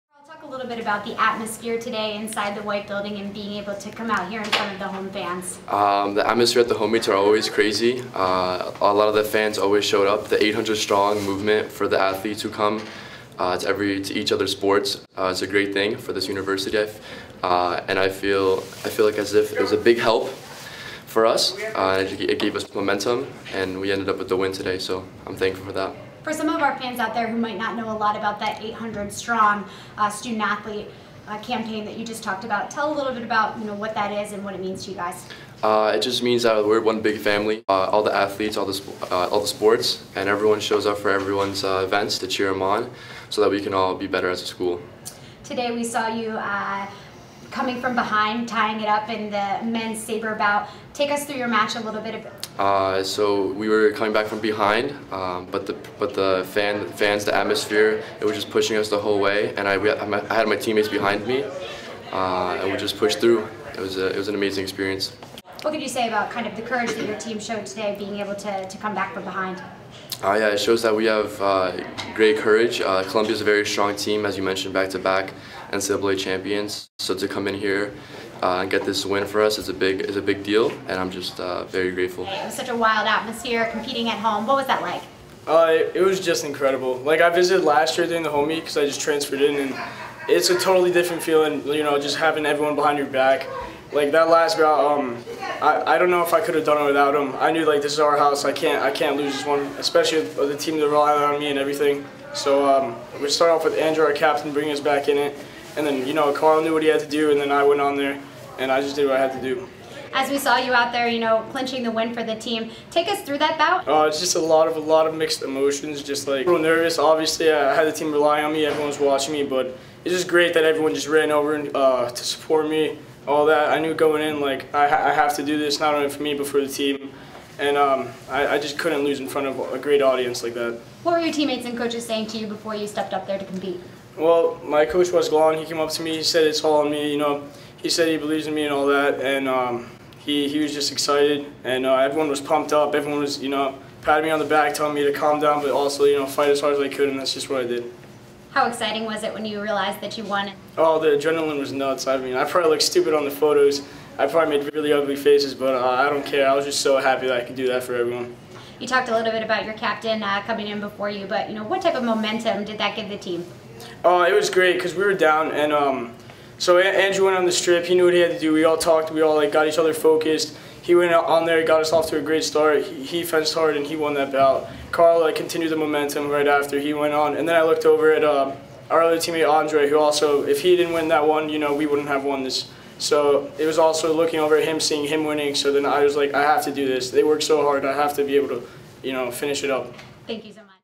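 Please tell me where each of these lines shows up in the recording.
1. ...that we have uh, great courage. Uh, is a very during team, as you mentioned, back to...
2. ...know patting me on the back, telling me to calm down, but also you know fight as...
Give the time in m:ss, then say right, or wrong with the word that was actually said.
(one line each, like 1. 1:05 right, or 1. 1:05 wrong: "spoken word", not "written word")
1. 1:10 wrong: "strong", not "during"
2. 2:23 right.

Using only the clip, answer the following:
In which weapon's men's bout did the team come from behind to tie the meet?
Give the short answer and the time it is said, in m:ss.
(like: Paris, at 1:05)
Saber, at 0:50.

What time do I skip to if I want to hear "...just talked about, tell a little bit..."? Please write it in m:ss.
0:32.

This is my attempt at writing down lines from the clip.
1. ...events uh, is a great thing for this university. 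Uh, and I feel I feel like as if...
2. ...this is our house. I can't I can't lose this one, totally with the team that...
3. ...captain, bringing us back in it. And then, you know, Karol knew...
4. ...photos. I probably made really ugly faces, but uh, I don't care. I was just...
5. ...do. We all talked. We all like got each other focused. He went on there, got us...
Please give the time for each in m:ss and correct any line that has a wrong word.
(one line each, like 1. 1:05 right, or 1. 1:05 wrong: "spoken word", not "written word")
1. 0:14 wrong: "sports", not "events"
2. 1:37 wrong: "especially", not "totally"
3. 1:44 right
4. 2:33 right
5. 2:48 right.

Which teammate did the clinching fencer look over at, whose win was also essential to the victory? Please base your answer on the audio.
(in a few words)
Andre.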